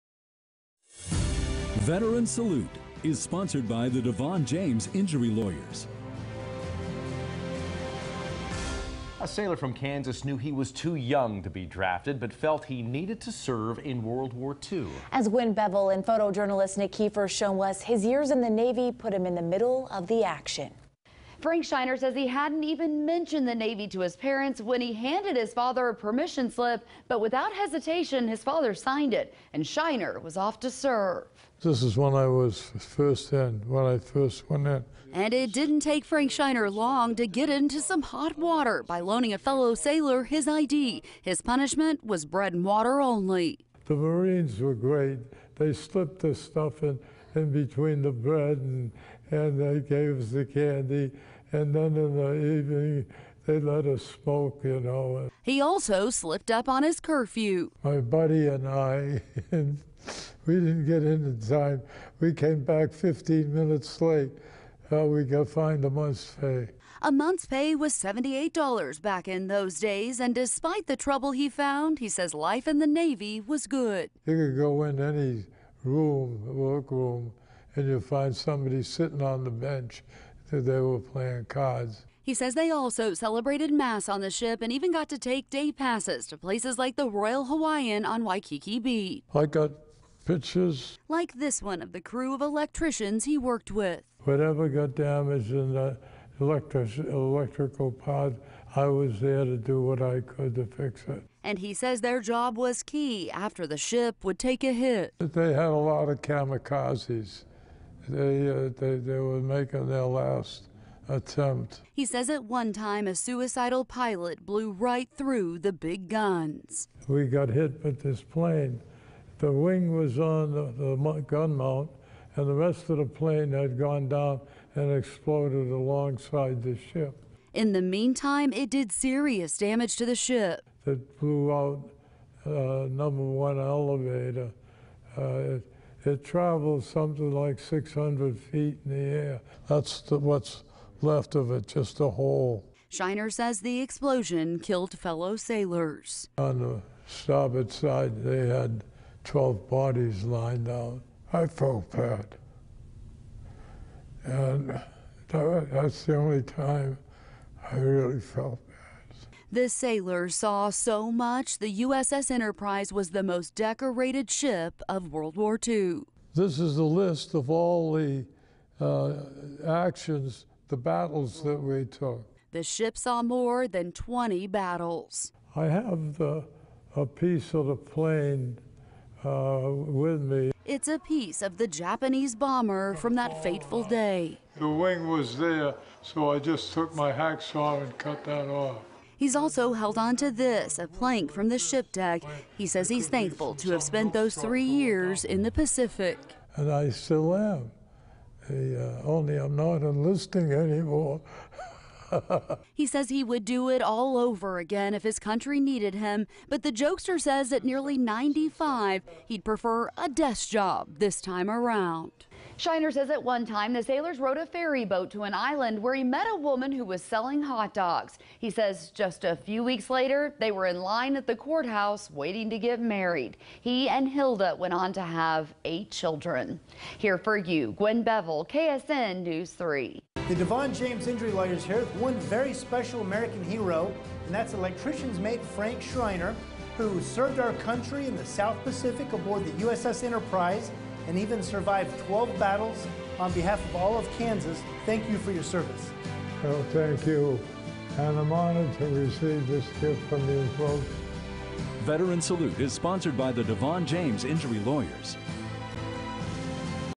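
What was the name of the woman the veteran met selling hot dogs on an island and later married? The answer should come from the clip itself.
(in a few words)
Hilda.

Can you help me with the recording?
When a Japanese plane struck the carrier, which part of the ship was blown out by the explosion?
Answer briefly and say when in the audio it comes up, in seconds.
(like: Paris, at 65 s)
Number one elevator, at 132 s.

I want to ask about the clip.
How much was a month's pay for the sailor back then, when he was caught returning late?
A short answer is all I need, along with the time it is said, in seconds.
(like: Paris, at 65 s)
$78, at 67 s.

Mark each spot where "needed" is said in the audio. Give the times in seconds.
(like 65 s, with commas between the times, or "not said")
12 s, 205 s.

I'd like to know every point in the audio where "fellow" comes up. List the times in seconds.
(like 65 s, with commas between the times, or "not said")
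39 s, 144 s.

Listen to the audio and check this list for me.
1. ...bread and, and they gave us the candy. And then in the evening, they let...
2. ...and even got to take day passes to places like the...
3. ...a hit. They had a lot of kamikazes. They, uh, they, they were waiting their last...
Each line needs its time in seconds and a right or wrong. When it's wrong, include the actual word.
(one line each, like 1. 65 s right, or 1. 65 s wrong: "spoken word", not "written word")
1. 48 s right
2. 84 s right
3. 104 s wrong: "making", not "waiting".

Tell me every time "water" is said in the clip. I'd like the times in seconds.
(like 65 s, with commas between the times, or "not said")
38 s, 42 s.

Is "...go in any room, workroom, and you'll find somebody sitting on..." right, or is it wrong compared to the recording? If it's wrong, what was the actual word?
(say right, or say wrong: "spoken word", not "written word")
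right.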